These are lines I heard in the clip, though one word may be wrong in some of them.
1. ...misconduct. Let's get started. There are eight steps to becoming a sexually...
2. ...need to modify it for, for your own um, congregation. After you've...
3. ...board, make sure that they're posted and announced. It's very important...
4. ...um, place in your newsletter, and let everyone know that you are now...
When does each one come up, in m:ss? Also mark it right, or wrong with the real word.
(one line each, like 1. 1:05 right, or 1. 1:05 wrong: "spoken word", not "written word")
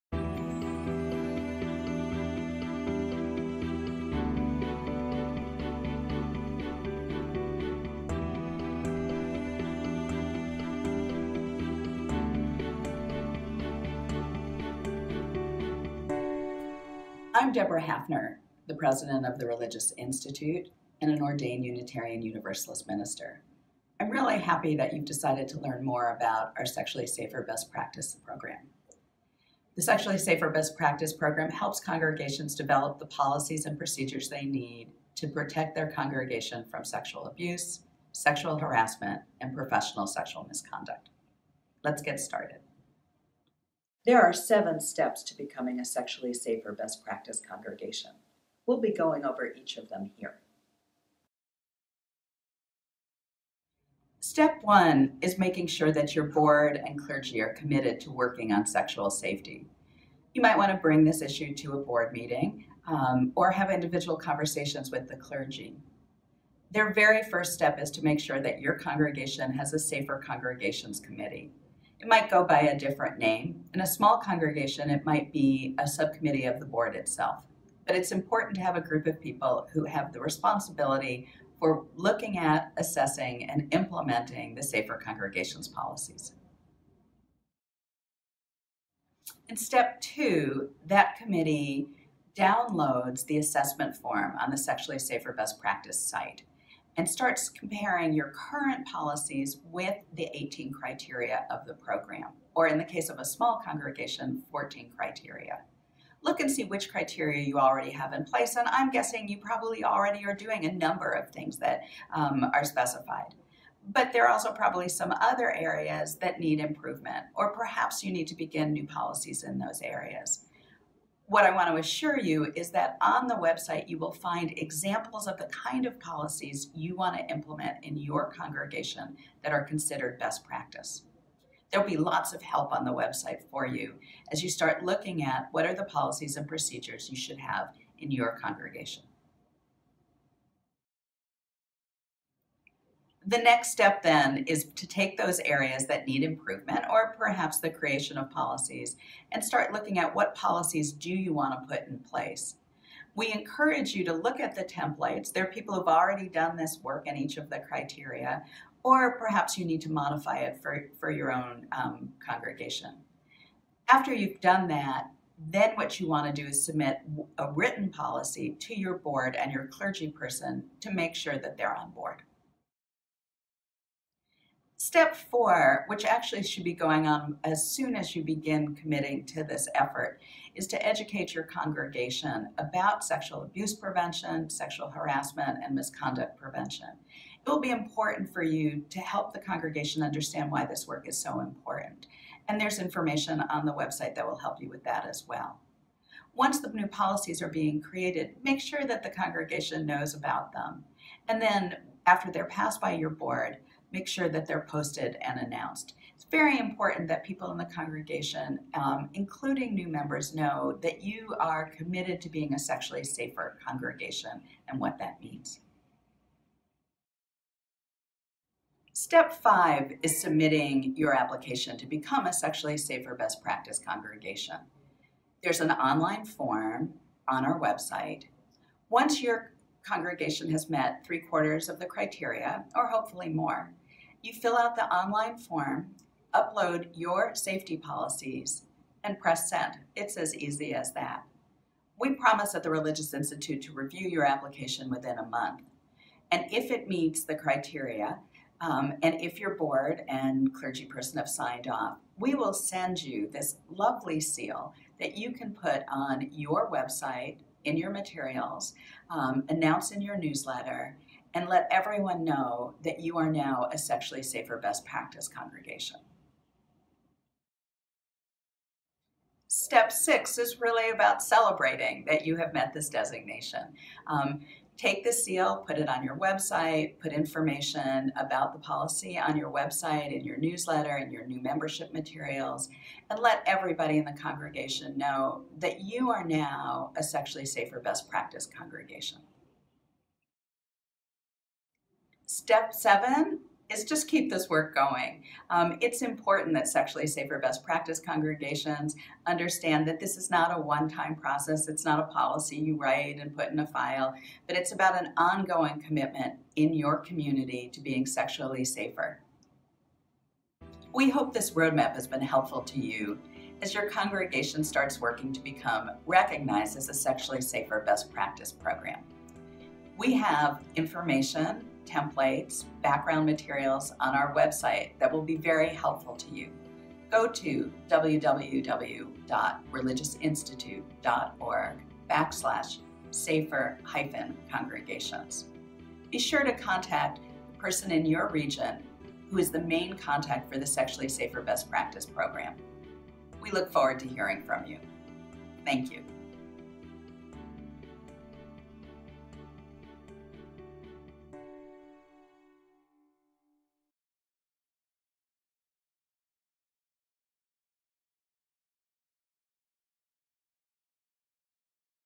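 1. 0:40 wrong: "seven", not "eight"
2. 2:39 right
3. 3:23 right
4. 4:19 wrong: "announce", not "place".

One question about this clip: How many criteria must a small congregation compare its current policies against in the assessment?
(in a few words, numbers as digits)
14.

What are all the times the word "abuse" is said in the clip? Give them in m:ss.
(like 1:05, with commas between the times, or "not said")
0:37, 3:03.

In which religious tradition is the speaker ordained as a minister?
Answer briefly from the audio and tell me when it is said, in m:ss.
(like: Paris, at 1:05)
Unitarian Universalist, at 0:21.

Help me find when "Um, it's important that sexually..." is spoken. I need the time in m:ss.
4:55.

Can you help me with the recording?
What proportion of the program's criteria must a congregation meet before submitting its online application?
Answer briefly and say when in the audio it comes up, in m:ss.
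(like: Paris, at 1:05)
three quarters, at 3:51.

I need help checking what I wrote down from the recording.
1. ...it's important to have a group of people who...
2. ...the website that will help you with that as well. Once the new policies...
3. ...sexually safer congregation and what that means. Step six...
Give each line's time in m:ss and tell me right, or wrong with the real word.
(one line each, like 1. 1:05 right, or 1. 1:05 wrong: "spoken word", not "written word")
1. 1:17 right
2. 3:13 right
3. 3:32 wrong: "five", not "six".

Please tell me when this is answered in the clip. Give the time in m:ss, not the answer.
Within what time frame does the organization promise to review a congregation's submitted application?
4:04.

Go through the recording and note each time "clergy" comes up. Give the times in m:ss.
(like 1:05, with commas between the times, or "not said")
0:56, 1:05, 2:49, 4:10.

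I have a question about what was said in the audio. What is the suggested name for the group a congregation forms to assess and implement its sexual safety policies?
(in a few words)
Safer Congregations Committee.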